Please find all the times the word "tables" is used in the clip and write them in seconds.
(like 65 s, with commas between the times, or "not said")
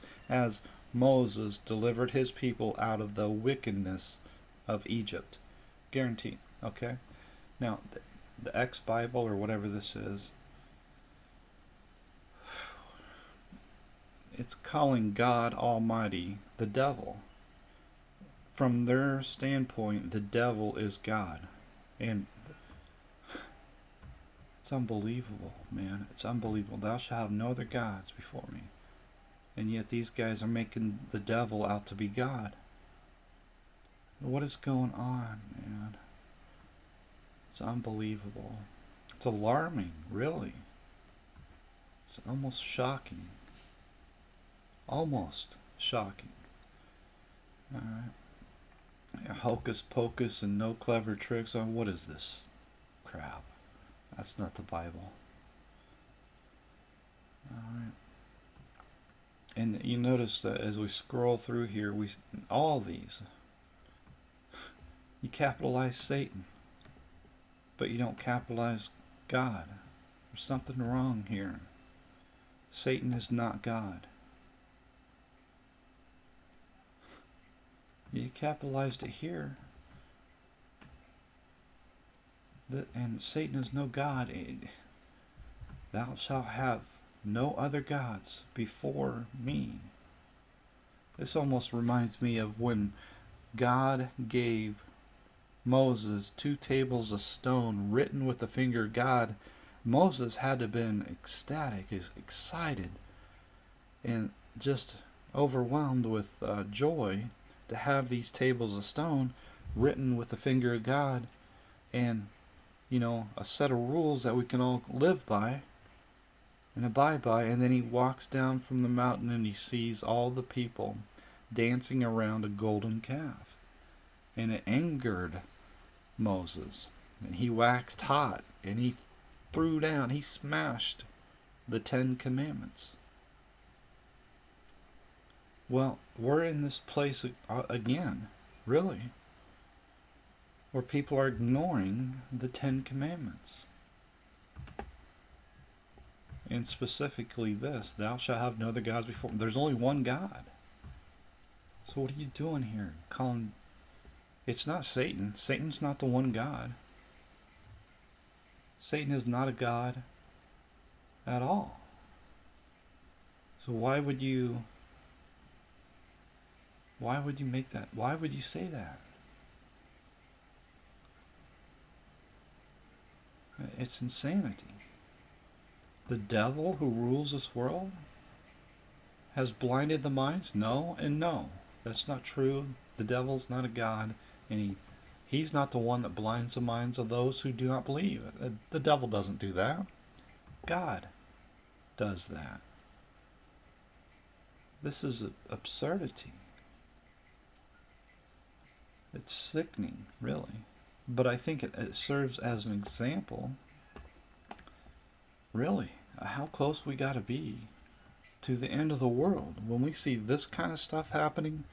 96 s, 108 s.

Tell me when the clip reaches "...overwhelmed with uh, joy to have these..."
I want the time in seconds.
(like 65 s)
105 s.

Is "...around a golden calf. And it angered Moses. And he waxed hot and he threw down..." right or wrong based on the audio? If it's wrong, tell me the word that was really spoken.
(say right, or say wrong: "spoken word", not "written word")
right.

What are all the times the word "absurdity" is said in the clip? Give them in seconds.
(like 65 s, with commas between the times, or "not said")
195 s.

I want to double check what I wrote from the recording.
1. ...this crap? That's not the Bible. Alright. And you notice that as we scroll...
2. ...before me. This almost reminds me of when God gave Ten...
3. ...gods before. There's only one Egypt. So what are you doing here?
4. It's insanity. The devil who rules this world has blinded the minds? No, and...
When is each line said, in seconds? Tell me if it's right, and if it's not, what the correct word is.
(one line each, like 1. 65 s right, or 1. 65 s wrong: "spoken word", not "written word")
1. 52 s right
2. 88 s wrong: "Moses", not "Ten"
3. 148 s wrong: "God", not "Egypt"
4. 173 s right.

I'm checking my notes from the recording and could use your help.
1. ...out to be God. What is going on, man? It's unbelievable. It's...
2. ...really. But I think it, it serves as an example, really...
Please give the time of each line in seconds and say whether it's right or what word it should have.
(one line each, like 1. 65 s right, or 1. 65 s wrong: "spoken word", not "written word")
1. 31 s right
2. 200 s right.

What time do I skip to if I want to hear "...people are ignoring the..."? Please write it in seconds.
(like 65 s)
140 s.